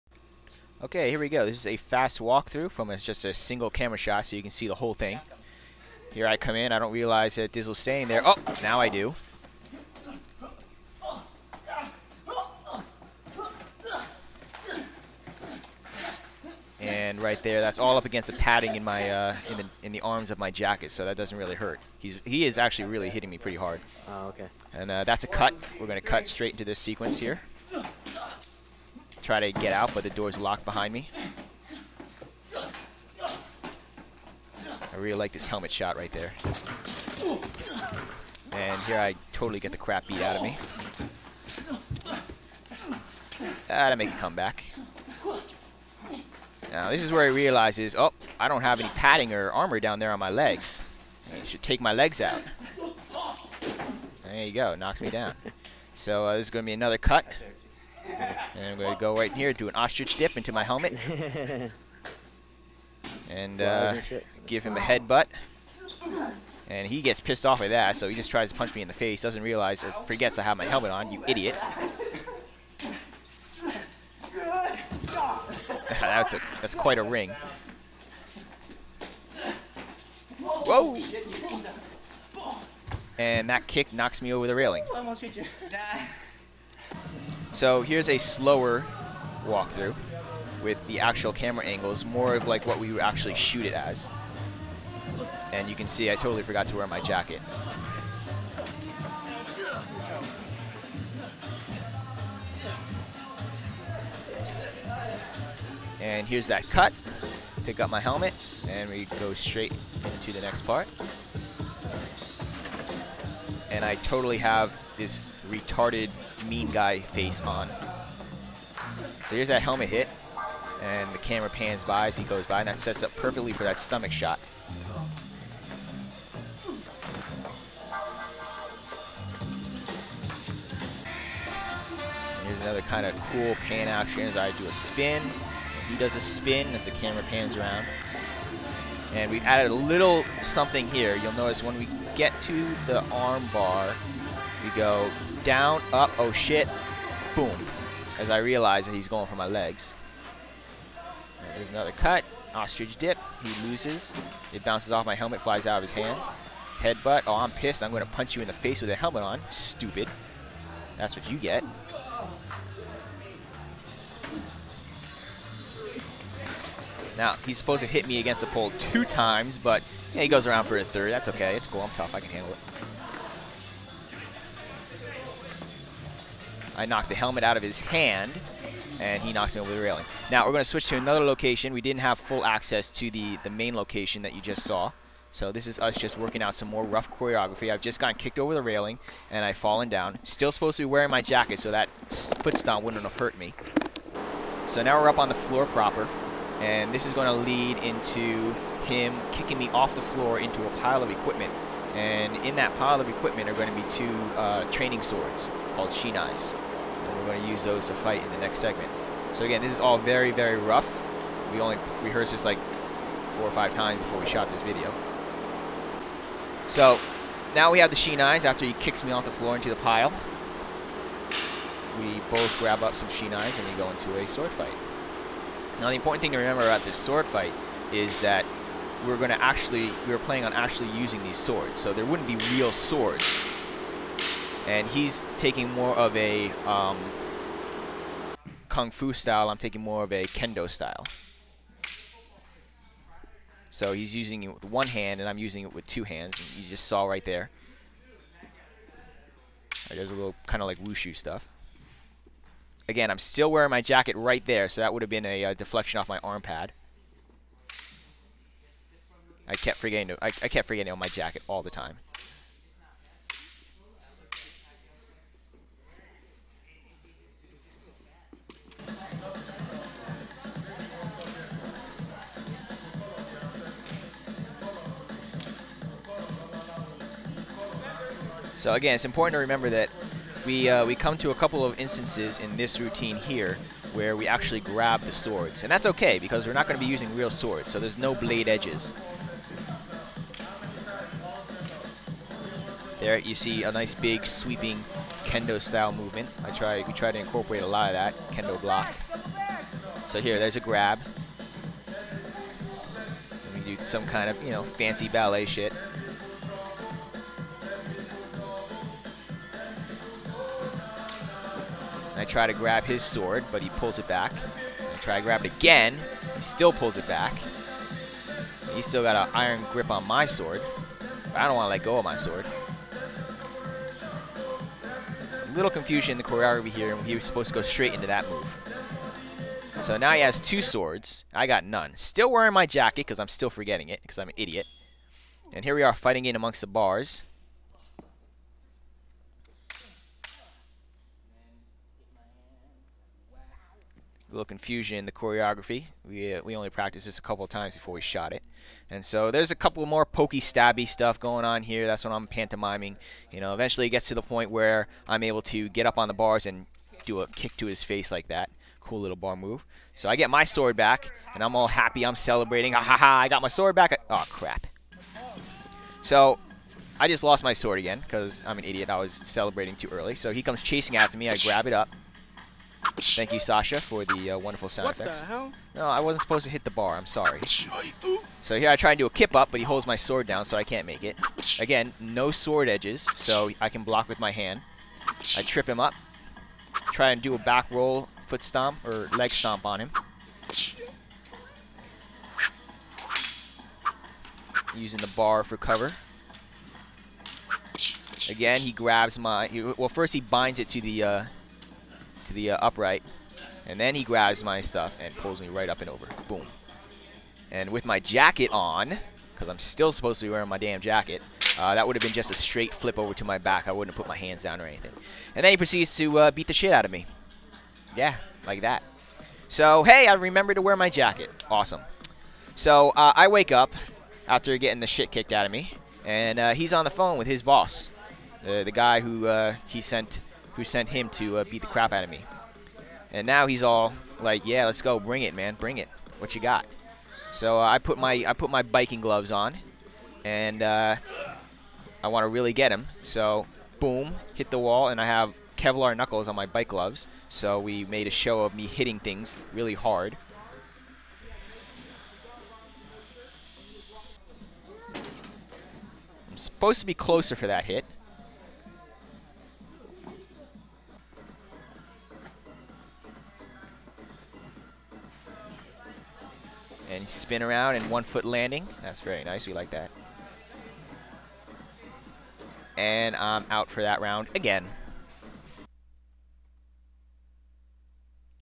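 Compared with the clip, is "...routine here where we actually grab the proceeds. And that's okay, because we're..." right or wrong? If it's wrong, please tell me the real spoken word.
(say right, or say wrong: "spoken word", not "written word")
wrong: "swords", not "proceeds".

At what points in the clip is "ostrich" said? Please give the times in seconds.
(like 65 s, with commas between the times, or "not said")
59 s, 152 s.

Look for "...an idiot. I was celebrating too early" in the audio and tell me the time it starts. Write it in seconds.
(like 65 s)
368 s.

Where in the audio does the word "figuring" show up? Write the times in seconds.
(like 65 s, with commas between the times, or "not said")
not said.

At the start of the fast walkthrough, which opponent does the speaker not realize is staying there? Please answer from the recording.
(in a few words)
Dizzle.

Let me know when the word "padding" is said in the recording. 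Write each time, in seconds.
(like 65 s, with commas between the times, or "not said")
18 s, 48 s.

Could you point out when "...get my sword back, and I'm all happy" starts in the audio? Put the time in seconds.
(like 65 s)
360 s.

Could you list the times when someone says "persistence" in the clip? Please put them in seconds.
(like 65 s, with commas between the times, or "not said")
not said.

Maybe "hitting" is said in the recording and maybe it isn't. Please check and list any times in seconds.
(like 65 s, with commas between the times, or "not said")
23 s, 448 s.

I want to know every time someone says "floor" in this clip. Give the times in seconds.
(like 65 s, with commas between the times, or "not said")
195 s, 200 s, 219 s.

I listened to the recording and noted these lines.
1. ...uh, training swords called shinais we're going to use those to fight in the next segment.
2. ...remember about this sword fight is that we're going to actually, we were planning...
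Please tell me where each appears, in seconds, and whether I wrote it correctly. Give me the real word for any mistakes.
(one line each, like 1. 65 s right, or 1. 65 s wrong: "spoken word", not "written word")
1. 204 s right
2. 226 s right.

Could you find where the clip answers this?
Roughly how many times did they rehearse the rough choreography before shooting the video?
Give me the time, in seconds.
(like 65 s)
213 s.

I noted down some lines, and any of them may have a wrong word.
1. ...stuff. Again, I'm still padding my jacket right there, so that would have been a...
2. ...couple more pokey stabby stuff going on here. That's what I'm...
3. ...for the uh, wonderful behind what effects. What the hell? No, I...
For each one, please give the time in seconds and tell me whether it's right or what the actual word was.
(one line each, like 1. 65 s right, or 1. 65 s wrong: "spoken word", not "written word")
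1. 251 s wrong: "wearing", not "padding"
2. 349 s right
3. 373 s wrong: "sound", not "behind".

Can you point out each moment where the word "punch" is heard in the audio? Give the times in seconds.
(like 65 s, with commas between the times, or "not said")
68 s, 158 s.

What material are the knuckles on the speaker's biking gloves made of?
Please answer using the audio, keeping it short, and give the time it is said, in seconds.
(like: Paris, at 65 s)
Kevlar, at 445 s.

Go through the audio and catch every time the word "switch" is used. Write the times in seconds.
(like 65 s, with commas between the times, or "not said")
180 s.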